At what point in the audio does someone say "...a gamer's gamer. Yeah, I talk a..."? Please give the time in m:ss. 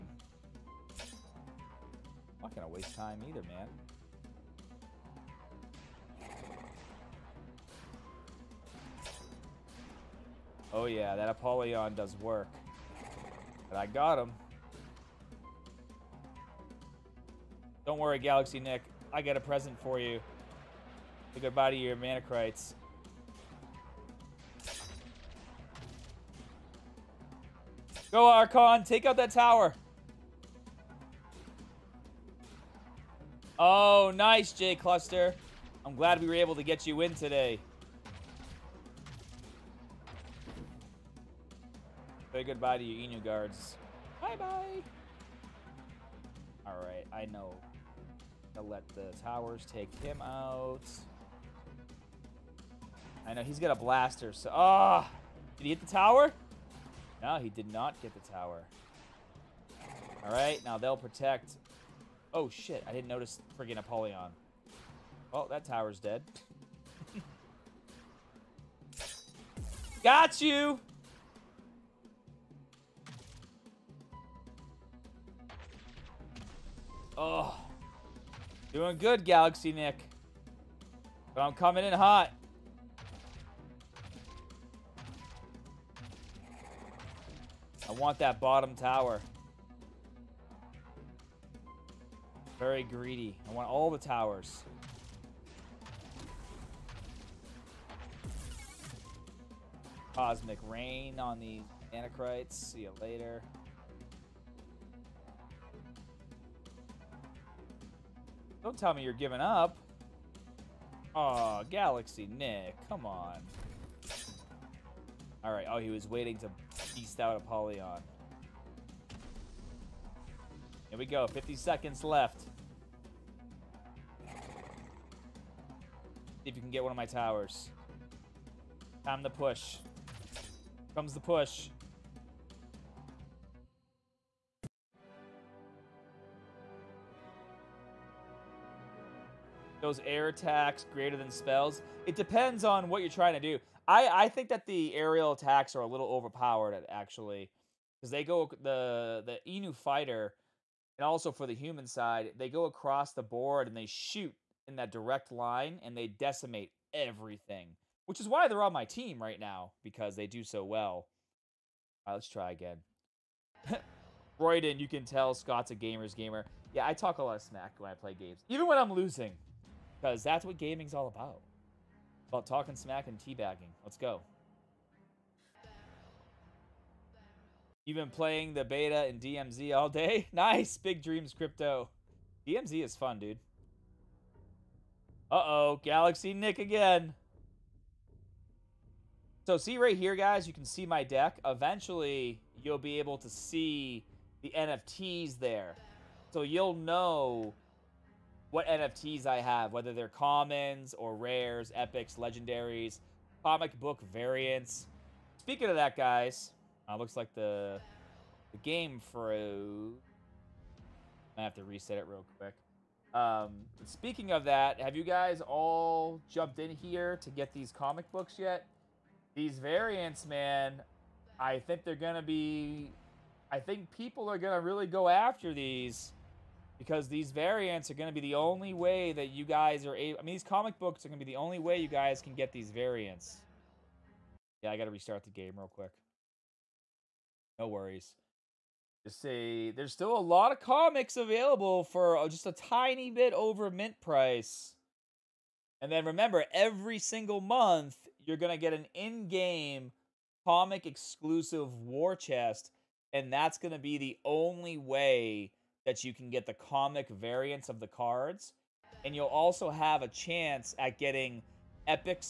2:45.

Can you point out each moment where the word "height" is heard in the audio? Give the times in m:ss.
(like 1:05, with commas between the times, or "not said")
not said.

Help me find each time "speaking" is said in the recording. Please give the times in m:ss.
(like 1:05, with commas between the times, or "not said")
3:25, 3:33.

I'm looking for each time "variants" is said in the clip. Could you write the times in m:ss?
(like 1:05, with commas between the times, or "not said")
3:24, 3:39, 3:47, 3:52, 4:17.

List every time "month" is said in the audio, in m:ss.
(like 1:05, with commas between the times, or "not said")
4:07.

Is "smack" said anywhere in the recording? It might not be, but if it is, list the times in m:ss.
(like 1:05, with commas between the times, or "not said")
2:47, 2:52.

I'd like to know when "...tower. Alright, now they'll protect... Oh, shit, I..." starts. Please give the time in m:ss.
0:58.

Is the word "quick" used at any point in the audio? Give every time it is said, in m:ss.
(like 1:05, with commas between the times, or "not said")
3:32, 3:55.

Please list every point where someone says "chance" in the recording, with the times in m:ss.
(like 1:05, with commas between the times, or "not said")
4:20.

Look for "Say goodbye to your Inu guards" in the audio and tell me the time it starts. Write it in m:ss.
0:42.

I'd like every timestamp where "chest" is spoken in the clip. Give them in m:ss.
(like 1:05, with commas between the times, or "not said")
4:12.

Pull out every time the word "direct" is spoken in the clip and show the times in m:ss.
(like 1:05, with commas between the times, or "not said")
2:34.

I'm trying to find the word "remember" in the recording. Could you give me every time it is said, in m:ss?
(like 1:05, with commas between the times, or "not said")
4:06.